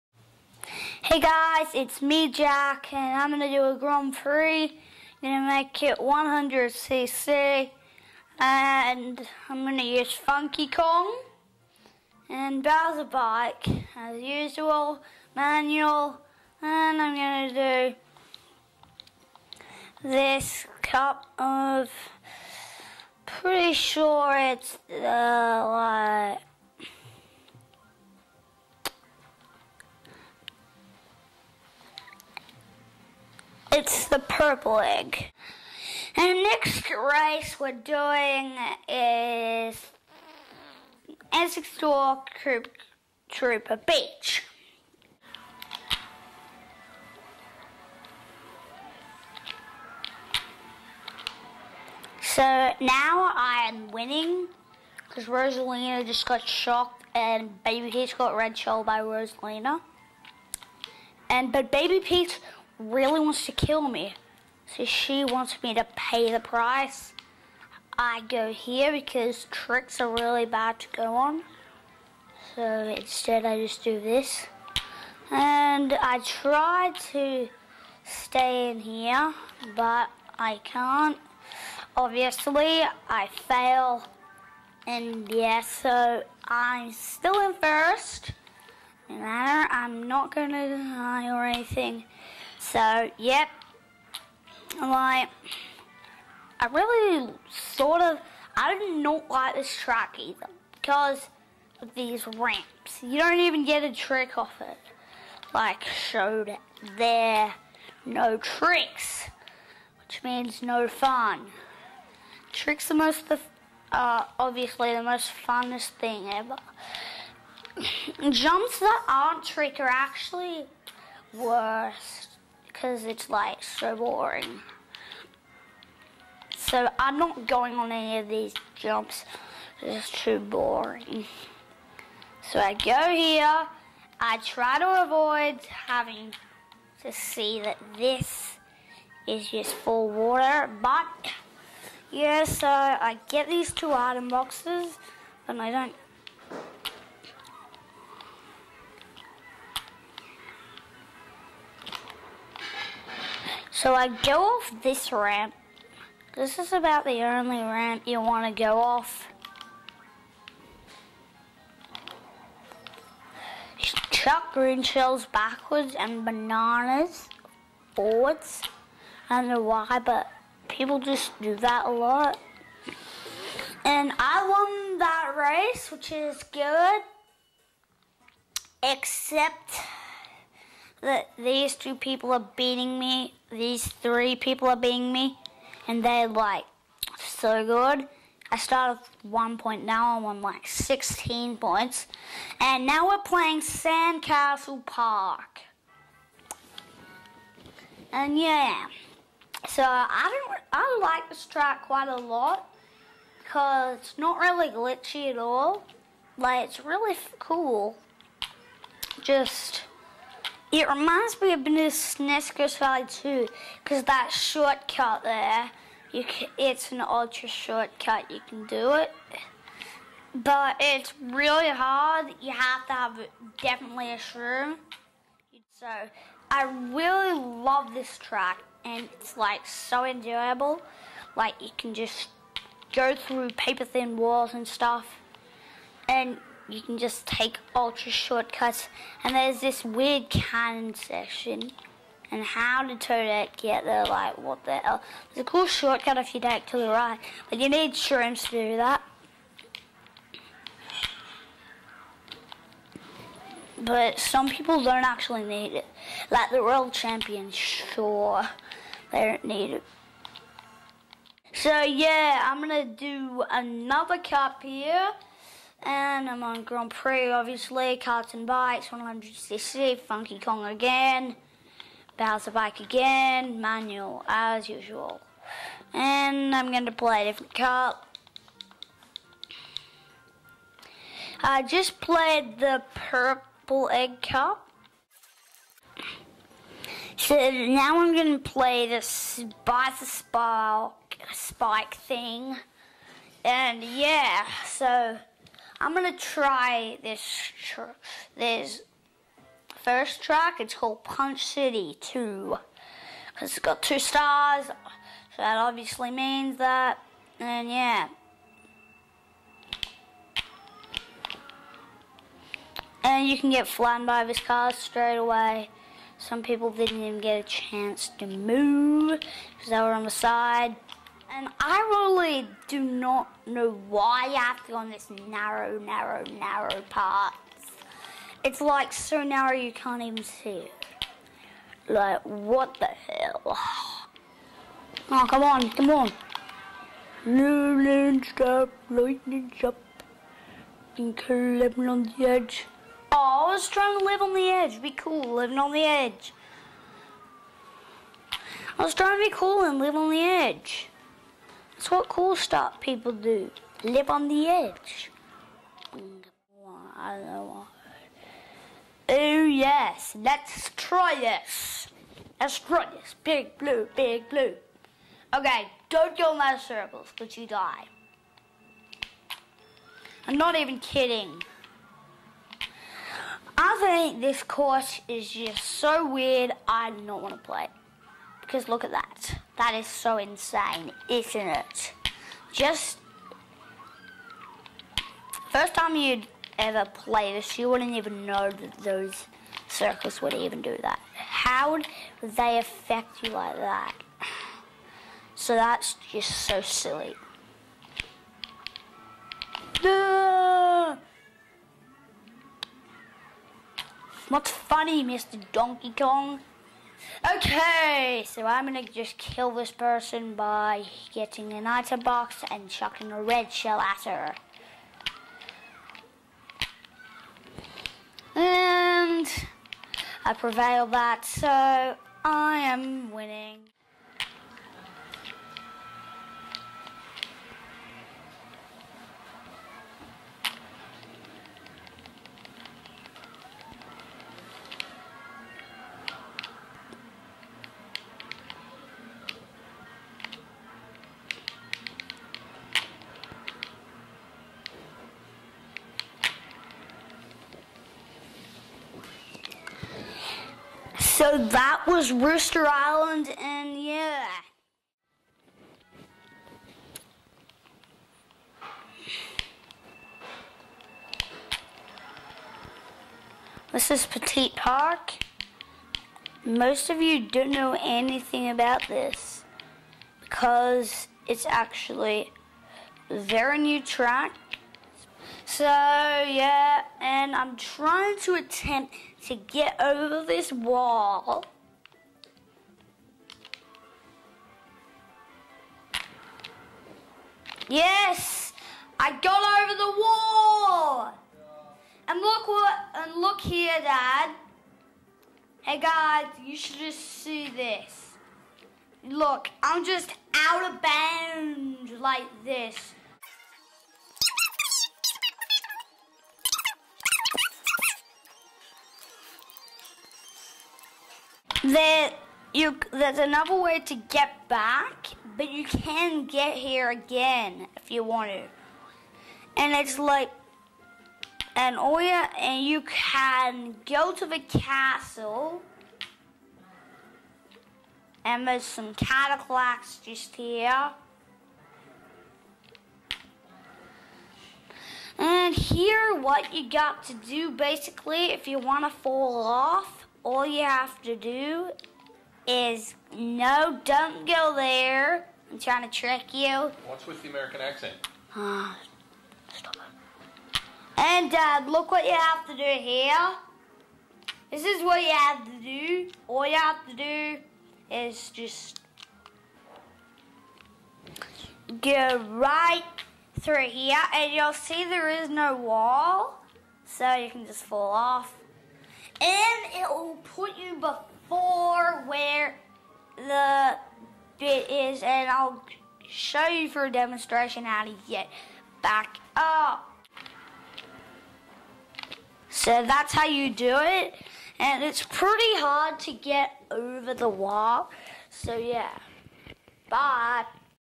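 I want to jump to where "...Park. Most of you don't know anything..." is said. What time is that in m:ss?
7:44.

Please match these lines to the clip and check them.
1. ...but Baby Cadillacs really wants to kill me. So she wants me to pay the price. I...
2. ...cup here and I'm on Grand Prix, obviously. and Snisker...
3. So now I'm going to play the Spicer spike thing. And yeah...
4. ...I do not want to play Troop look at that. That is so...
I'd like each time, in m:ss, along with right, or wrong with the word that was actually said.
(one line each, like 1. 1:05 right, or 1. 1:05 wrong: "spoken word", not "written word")
1. 1:01 wrong: "Peach", not "Cadillacs"
2. 4:24 wrong: "Bikes", not "Snisker"
3. 4:47 right
4. 6:16 wrong: "Because", not "Troop".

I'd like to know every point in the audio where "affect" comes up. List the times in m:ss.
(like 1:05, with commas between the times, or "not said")
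6:32.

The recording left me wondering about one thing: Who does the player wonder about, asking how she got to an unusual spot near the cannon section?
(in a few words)
Toadette.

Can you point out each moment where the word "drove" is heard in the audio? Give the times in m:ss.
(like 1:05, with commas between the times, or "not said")
not said.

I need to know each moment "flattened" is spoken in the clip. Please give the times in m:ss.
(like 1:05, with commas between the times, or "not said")
5:13.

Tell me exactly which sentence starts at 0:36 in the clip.
And next race we're doing is Essex Door Troop, Trooper Beach.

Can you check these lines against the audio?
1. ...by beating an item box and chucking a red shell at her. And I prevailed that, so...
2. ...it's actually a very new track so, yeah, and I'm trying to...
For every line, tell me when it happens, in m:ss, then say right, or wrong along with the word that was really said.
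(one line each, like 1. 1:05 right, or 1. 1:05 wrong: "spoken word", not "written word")
1. 6:50 wrong: "getting", not "beating"
2. 7:51 right.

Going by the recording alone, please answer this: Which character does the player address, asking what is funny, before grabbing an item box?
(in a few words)
Donkey Kong.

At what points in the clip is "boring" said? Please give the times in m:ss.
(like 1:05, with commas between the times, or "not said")
2:03, 2:10.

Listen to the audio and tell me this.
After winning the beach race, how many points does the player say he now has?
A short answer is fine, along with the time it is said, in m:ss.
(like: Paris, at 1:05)
16, at 3:10.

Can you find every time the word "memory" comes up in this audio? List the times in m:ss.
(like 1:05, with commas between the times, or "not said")
not said.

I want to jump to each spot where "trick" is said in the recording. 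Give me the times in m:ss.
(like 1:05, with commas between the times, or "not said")
1:09, 1:43, 1:48, 1:52, 1:59, 9:05.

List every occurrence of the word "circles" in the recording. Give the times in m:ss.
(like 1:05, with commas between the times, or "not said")
6:06, 6:29.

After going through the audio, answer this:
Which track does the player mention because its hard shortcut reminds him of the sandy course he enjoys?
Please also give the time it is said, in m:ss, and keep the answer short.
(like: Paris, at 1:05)
Snisker's Valley, at 3:31.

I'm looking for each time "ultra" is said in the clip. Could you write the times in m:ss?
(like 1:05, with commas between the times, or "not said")
3:37, 3:57.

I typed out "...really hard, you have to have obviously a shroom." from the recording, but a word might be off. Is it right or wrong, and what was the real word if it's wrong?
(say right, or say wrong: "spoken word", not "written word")
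wrong: "definitely", not "obviously".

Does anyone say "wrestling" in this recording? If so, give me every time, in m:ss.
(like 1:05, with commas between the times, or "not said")
not said.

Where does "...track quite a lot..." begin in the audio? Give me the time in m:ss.
3:21.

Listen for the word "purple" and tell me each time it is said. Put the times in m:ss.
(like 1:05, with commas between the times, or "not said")
0:34, 4:42.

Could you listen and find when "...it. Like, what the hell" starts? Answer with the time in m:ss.
5:30.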